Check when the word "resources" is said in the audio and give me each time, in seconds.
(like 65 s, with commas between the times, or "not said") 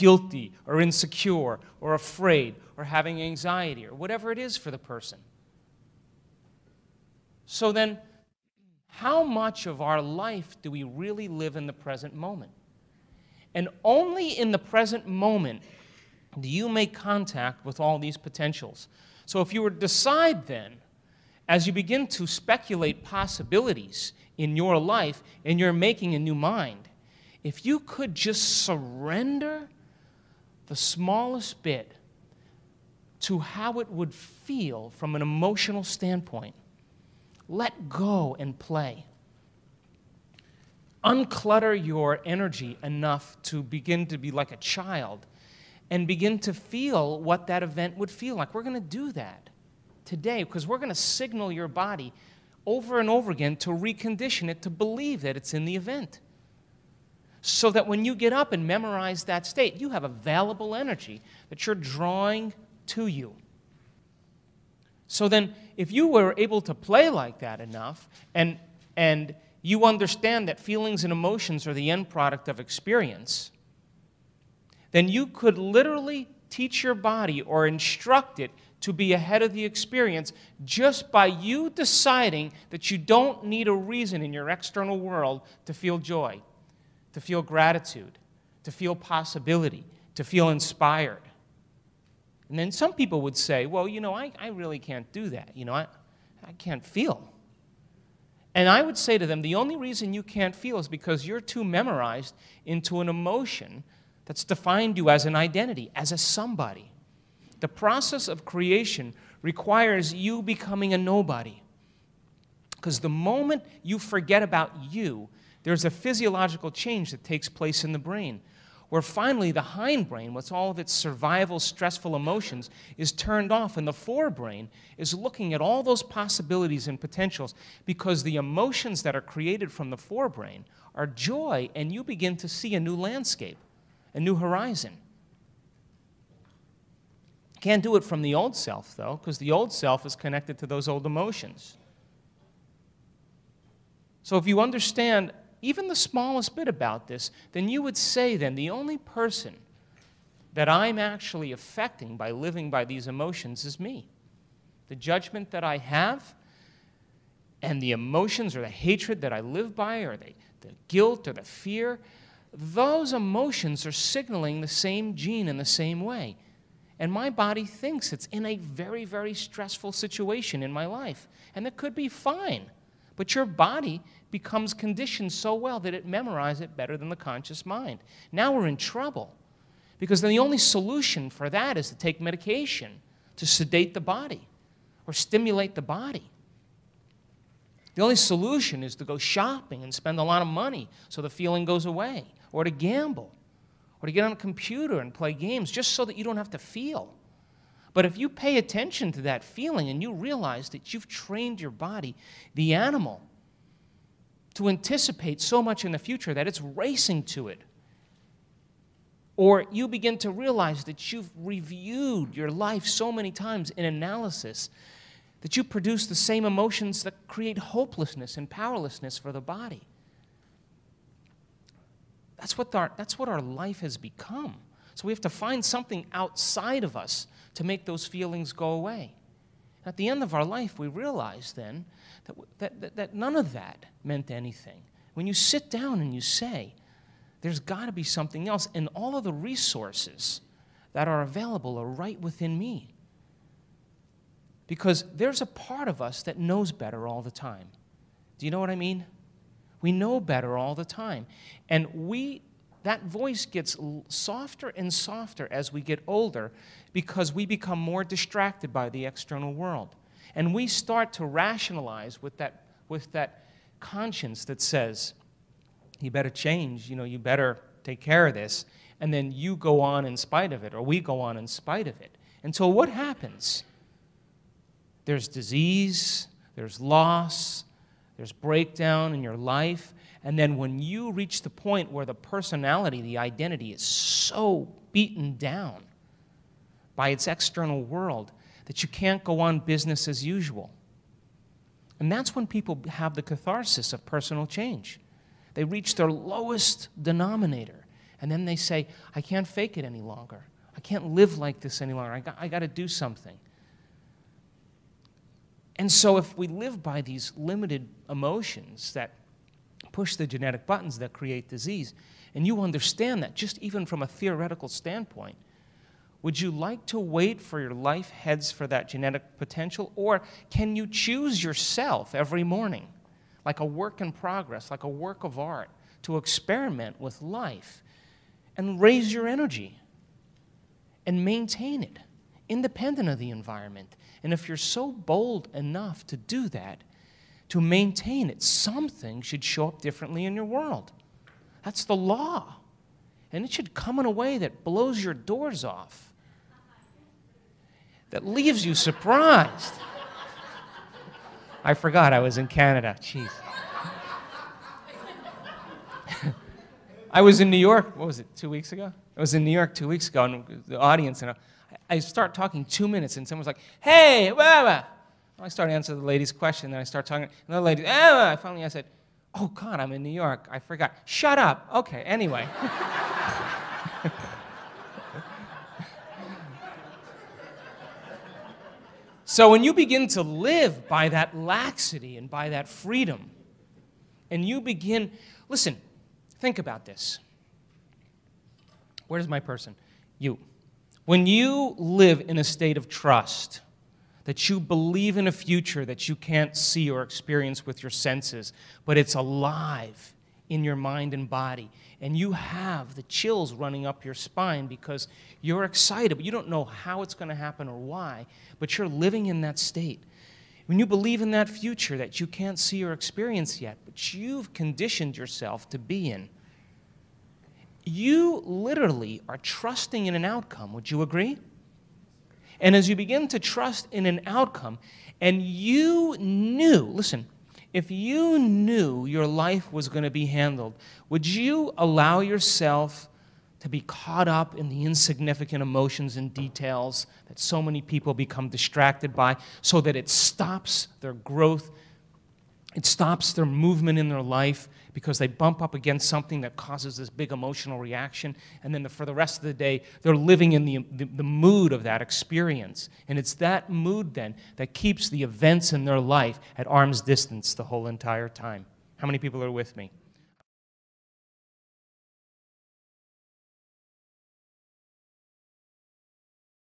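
239 s.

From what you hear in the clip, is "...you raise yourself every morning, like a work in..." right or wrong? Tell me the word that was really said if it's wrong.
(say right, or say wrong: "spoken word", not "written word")
wrong: "choose", not "raise".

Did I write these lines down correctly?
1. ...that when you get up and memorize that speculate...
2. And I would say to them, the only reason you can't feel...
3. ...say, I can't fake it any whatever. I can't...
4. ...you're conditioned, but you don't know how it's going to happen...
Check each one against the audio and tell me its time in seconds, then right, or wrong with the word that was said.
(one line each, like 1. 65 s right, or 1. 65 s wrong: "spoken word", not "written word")
1. 57 s wrong: "state", not "speculate"
2. 98 s right
3. 298 s wrong: "longer", not "whatever"
4. 405 s wrong: "excited", not "conditioned".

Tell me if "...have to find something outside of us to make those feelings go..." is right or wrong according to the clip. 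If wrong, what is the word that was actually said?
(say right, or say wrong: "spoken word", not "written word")
right.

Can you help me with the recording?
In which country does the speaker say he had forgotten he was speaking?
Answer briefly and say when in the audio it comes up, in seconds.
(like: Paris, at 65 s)
Canada, at 352 s.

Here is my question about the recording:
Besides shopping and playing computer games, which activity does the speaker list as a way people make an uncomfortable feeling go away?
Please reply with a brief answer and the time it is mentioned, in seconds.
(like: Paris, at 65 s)
gamble, at 192 s.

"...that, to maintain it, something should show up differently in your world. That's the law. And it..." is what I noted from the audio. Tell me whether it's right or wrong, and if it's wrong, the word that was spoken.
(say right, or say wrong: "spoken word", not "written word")
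right.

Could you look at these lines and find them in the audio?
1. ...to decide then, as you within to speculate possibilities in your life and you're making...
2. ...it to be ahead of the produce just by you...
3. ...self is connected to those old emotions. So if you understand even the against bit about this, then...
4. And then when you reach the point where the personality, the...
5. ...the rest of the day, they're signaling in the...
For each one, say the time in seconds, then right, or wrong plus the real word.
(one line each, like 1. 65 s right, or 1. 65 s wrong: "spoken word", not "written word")
1. 19 s wrong: "begin", not "within"
2. 78 s wrong: "experience", not "produce"
3. 139 s wrong: "smallest", not "against"
4. 280 s right
5. 449 s wrong: "living", not "signaling".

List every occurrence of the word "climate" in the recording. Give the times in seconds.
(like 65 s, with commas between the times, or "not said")
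not said.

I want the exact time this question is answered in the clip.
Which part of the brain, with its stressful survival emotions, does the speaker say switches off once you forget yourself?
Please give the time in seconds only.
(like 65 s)
119 s.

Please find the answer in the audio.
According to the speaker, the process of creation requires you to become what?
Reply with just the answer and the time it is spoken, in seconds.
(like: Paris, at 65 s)
a nobody, at 110 s.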